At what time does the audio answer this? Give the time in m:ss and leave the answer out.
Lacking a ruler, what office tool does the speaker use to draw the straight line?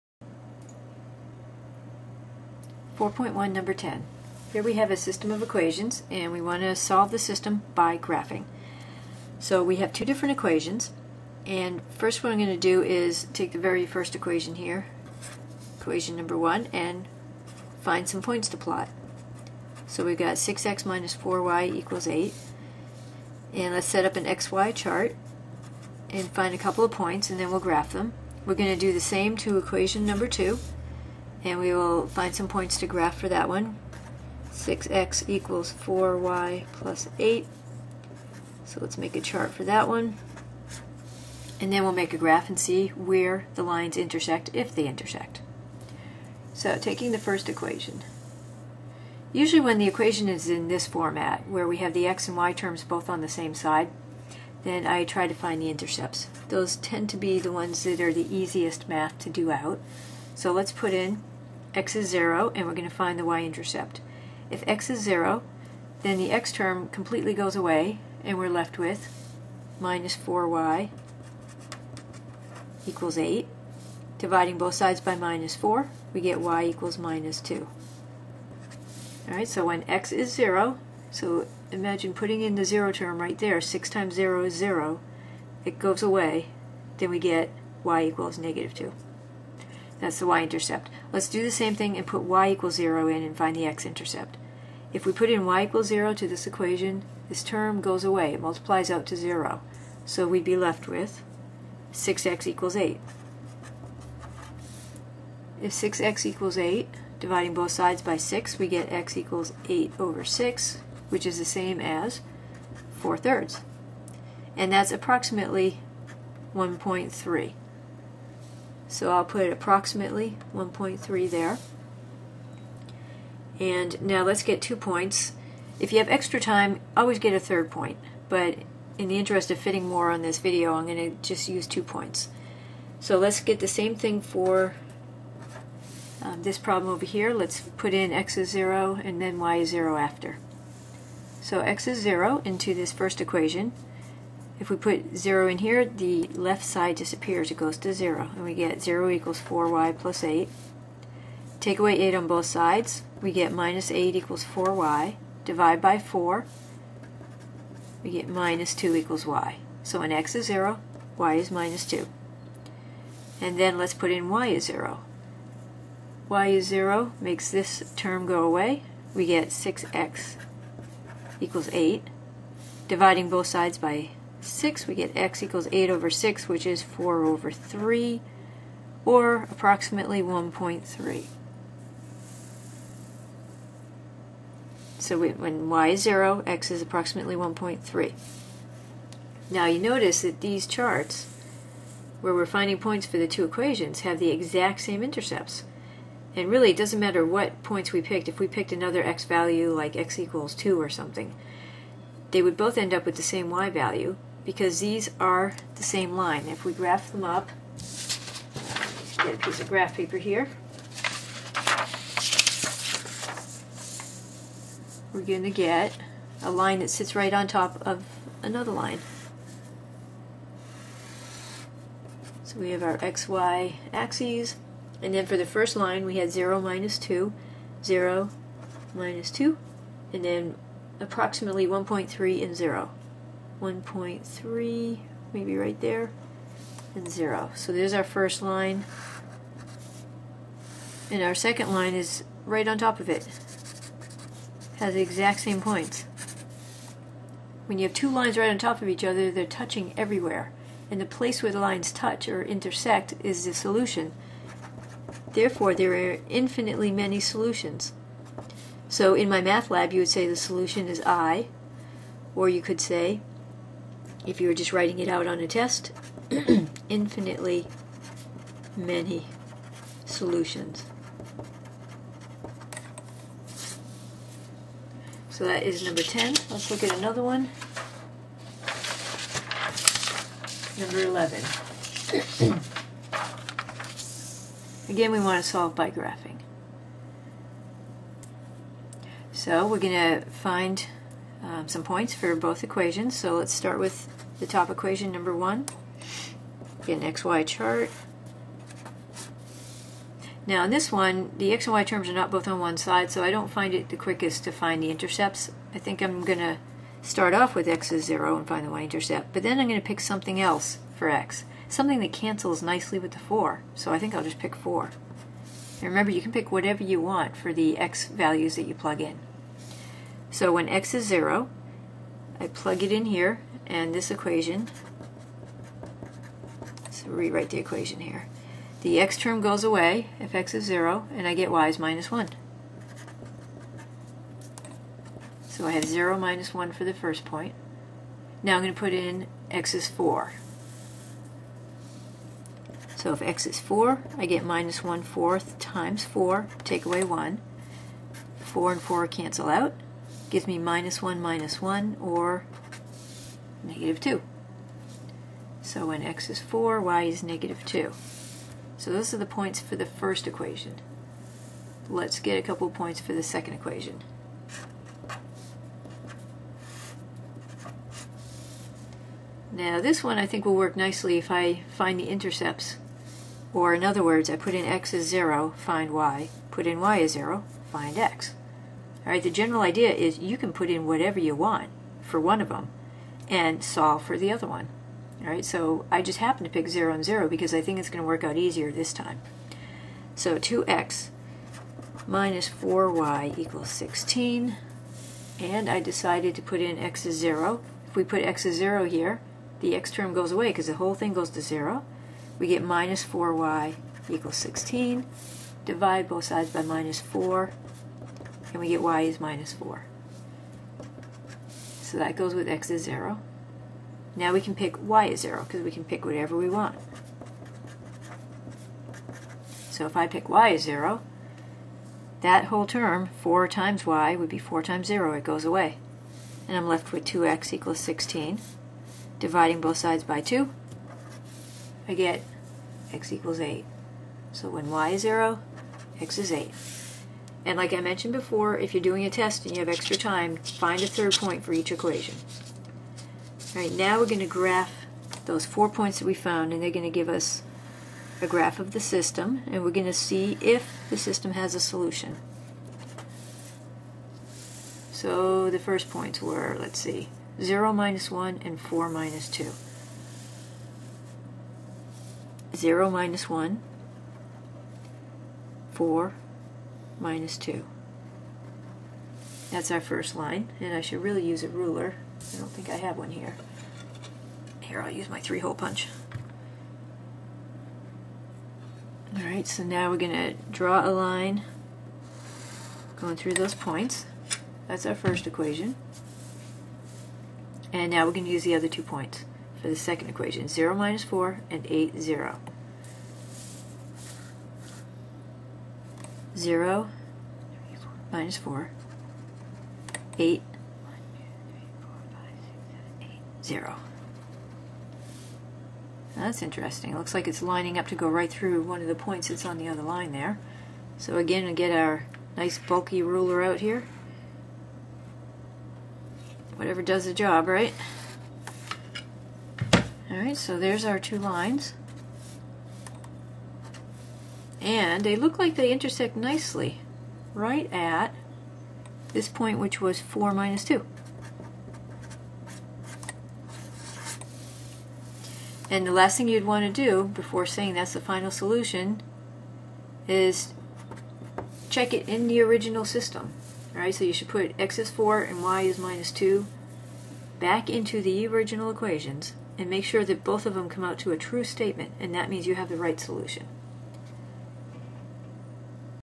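7:55.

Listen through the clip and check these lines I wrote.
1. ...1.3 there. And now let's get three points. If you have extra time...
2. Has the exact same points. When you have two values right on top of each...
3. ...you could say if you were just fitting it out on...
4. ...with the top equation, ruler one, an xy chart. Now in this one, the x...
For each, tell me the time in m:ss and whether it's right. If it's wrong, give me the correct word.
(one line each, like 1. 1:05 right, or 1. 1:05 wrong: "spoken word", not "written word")
1. 2:00 wrong: "two", not "three"
2. 4:04 wrong: "lines", not "values"
3. 4:22 wrong: "writing", not "fitting"
4. 4:53 wrong: "number", not "ruler".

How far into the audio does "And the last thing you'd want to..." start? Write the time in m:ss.
8:55.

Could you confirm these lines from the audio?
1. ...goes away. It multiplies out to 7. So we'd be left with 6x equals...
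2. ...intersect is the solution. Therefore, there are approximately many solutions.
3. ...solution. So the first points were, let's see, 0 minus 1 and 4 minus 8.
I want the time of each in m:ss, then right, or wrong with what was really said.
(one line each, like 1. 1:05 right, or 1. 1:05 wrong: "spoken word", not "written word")
1. 1:37 wrong: "0", not "7"
2. 4:12 wrong: "infinitely", not "approximately"
3. 7:31 wrong: "2", not "8".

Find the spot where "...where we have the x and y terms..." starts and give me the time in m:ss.
0:51.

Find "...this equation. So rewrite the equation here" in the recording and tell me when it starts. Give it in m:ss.
5:23.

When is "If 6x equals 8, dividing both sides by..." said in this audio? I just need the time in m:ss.
1:45.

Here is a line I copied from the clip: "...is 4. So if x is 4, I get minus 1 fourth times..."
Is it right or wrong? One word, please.
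right.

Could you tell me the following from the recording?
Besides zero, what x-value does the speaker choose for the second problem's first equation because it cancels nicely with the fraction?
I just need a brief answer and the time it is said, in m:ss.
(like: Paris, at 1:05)
4, at 5:14.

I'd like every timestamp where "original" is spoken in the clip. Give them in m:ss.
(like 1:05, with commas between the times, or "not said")
9:02, 9:08.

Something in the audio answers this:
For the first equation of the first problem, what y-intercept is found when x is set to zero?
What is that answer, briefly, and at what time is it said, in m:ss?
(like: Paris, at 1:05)
-2, at 1:16.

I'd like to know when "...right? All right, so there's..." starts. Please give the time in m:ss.
8:37.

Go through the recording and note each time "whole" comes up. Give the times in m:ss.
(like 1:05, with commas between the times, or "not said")
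6:40, 7:02.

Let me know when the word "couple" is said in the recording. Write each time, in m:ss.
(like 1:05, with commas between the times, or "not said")
0:26, 6:02.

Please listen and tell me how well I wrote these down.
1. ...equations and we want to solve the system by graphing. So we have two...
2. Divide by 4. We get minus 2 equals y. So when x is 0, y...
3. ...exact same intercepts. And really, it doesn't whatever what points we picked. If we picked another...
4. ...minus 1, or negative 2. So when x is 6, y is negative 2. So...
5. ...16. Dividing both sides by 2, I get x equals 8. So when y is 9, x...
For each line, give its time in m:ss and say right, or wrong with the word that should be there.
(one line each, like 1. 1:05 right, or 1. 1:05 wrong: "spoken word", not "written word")
1. 0:05 right
2. 2:35 right
3. 3:14 wrong: "matter", not "whatever"
4. 5:51 wrong: "4", not "6"
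5. 7:07 wrong: "0", not "9".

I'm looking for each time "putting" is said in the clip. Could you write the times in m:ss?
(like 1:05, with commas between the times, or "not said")
1:22.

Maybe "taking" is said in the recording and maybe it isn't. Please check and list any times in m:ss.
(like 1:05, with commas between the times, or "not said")
0:46.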